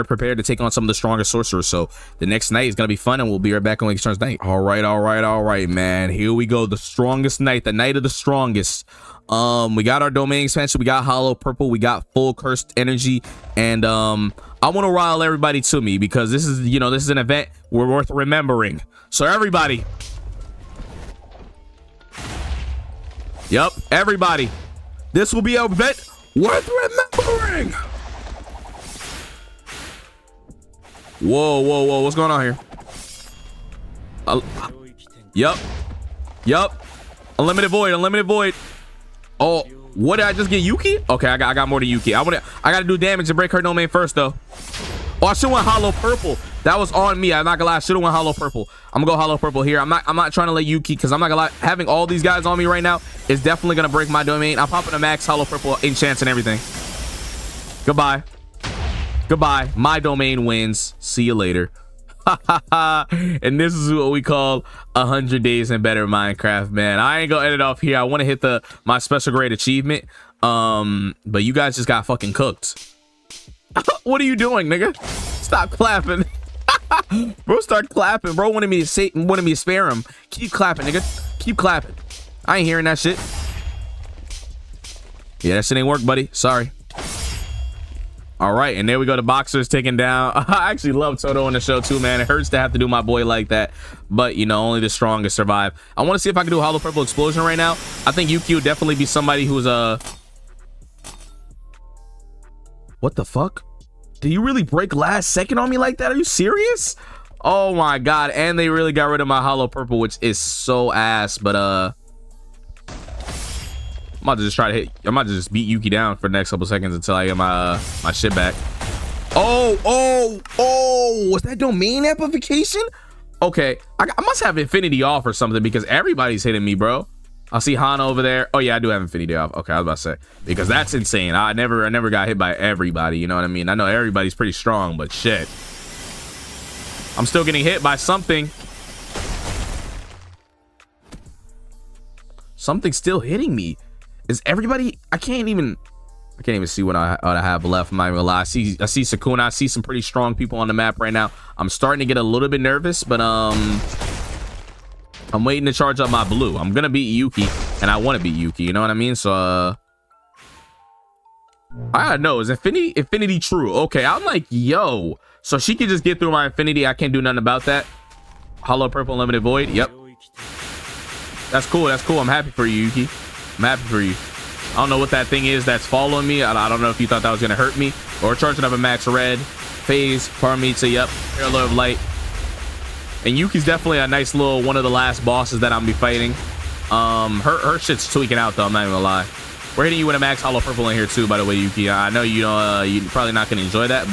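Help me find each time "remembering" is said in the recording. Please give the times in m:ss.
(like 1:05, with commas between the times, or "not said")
0:18, 0:27.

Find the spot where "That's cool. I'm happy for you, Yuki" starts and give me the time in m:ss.
2:51.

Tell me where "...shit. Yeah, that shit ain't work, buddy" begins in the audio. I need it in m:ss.
1:22.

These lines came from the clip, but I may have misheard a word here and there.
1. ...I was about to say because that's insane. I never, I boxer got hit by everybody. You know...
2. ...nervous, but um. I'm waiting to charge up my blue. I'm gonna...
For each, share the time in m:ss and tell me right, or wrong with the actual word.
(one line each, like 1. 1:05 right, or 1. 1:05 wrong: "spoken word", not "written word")
1. 2:09 wrong: "never", not "boxer"
2. 2:32 right.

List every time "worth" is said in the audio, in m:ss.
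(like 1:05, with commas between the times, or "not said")
0:17, 0:26.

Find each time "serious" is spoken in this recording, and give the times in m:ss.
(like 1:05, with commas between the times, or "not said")
1:46.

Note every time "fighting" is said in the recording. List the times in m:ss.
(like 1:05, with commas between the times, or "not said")
3:05.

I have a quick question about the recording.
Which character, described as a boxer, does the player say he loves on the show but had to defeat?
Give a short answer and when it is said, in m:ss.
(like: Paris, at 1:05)
Todo, at 1:31.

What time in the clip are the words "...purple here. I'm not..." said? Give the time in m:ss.
0:49.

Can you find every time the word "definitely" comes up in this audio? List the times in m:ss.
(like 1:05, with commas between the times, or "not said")
0:53, 1:38, 3:03.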